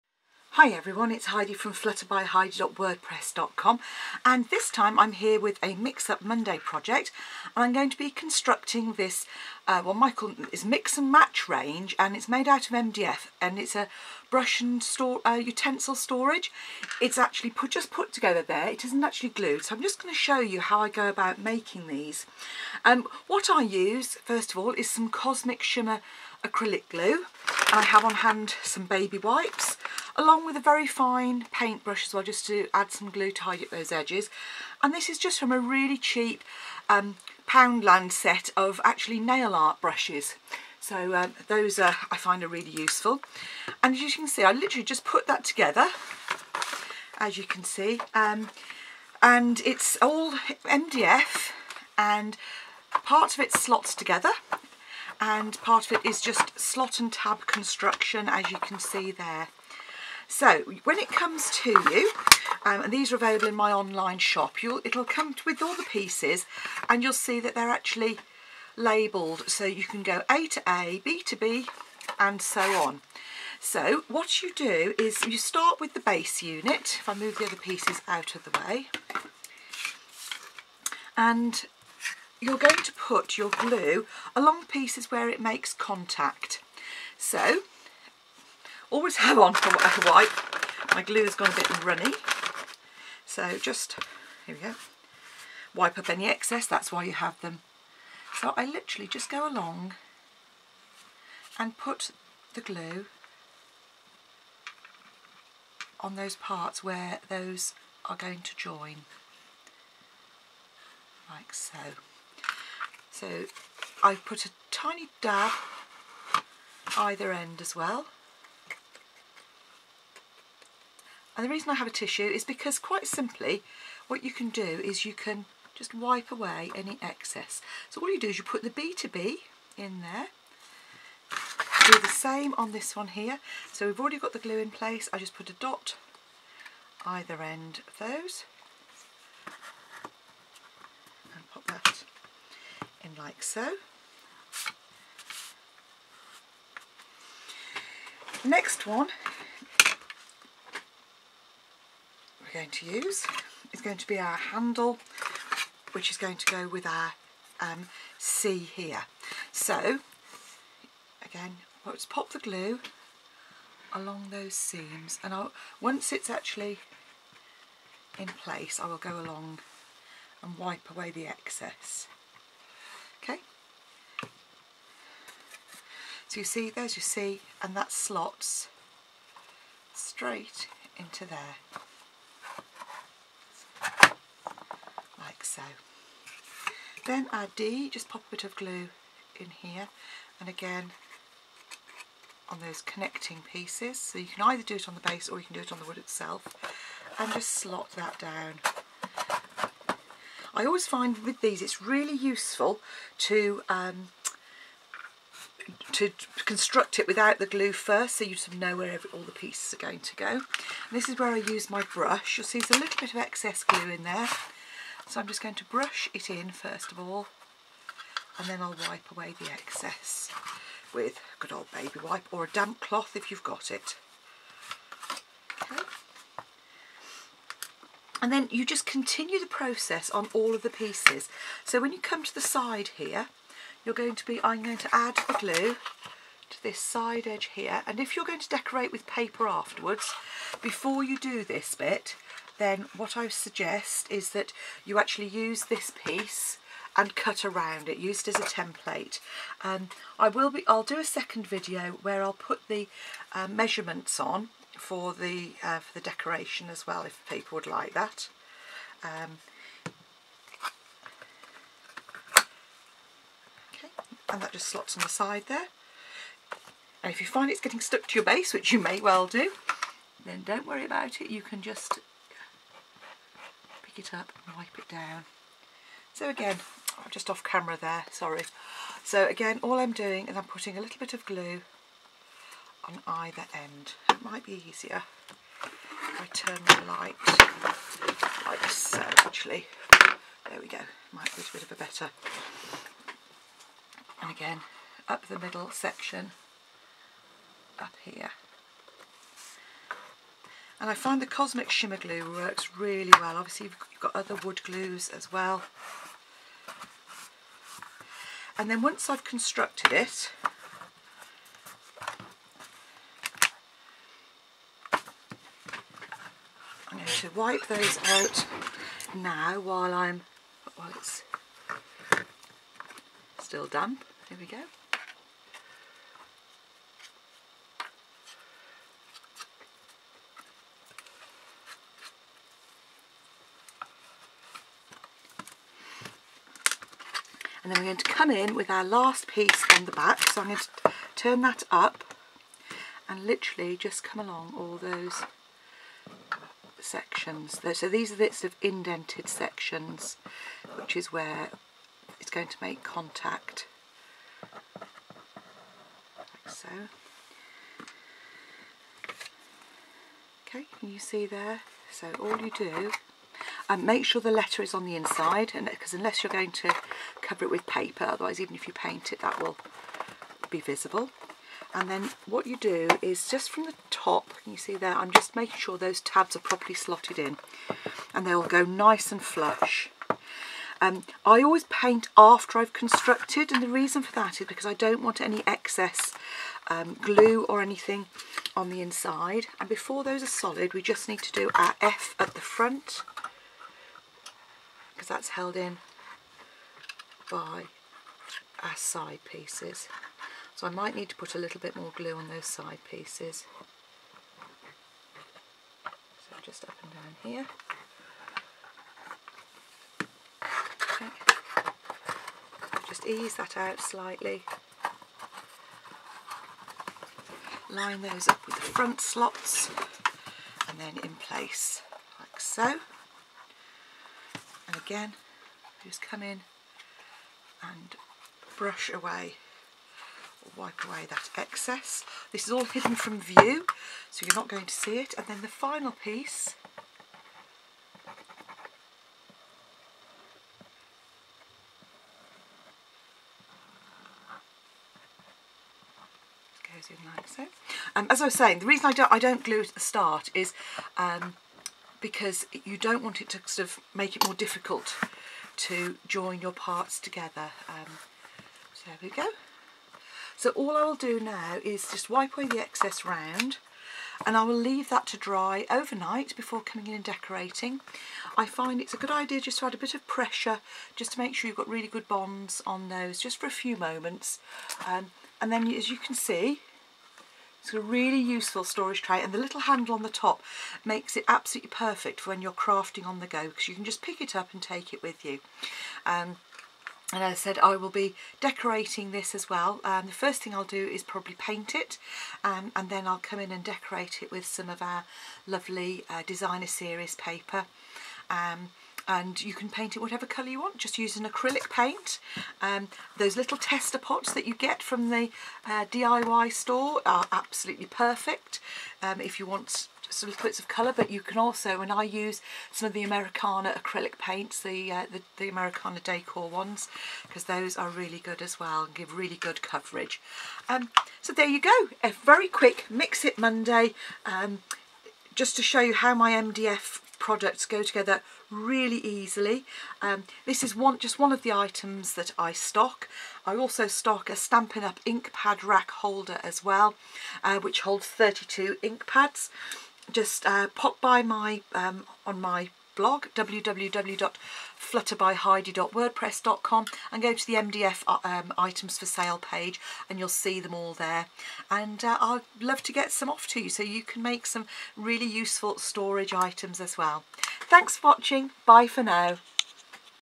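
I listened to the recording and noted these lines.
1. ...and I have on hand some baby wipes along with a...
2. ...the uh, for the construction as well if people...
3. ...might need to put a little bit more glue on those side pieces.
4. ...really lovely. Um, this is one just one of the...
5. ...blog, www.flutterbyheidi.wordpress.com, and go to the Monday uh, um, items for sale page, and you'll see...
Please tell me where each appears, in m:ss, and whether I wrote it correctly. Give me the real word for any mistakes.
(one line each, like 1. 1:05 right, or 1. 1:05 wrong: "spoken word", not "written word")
1. 0:27 right
2. 4:15 wrong: "decoration", not "construction"
3. 6:40 right
4. 8:48 wrong: "easily", not "lovely"
5. 9:02 wrong: "MDF", not "Monday".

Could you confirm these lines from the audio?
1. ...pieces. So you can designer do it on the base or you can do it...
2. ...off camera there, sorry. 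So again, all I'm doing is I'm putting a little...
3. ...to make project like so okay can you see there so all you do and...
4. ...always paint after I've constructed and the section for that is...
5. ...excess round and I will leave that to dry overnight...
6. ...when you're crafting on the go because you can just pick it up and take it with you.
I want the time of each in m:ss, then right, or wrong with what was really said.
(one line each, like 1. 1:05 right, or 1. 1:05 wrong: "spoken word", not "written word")
1. 3:13 wrong: "either", not "designer"
2. 4:37 right
3. 5:52 wrong: "contact", not "project"
4. 6:21 wrong: "reason", not "section"
5. 7:42 right
6. 8:02 right.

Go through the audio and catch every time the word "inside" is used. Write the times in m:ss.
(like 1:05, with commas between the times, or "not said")
6:04, 6:28.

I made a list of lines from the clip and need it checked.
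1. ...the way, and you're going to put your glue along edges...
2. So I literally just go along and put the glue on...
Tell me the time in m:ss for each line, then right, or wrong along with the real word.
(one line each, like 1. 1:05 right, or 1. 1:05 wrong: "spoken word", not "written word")
1. 1:18 wrong: "pieces", not "edges"
2. 1:38 right.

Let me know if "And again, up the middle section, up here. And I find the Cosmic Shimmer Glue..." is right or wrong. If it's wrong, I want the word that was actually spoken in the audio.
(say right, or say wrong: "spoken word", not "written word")
right.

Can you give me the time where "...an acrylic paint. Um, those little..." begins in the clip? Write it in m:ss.
8:21.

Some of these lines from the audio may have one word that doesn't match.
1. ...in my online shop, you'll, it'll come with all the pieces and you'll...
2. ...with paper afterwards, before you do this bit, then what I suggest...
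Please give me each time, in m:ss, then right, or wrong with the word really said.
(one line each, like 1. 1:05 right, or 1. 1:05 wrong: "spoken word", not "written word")
1. 1:03 right
2. 3:58 right.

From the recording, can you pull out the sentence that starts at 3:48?
And then you just continue the process on all of the pieces.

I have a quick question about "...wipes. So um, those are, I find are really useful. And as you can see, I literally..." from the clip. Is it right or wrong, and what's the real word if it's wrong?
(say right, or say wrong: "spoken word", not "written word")
wrong: "brushes", not "wipes".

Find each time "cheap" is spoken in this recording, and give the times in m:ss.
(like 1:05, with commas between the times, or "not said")
0:35.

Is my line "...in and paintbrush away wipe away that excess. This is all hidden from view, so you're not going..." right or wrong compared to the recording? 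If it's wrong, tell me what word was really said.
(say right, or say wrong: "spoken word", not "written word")
wrong: "brush", not "paintbrush".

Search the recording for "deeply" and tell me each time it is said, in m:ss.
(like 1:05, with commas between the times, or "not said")
not said.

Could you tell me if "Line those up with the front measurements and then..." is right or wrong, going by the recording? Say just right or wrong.
wrong.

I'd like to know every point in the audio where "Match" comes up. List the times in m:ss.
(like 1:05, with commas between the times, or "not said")
0:11.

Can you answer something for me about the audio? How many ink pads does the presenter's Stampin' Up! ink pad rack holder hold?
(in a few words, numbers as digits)
32.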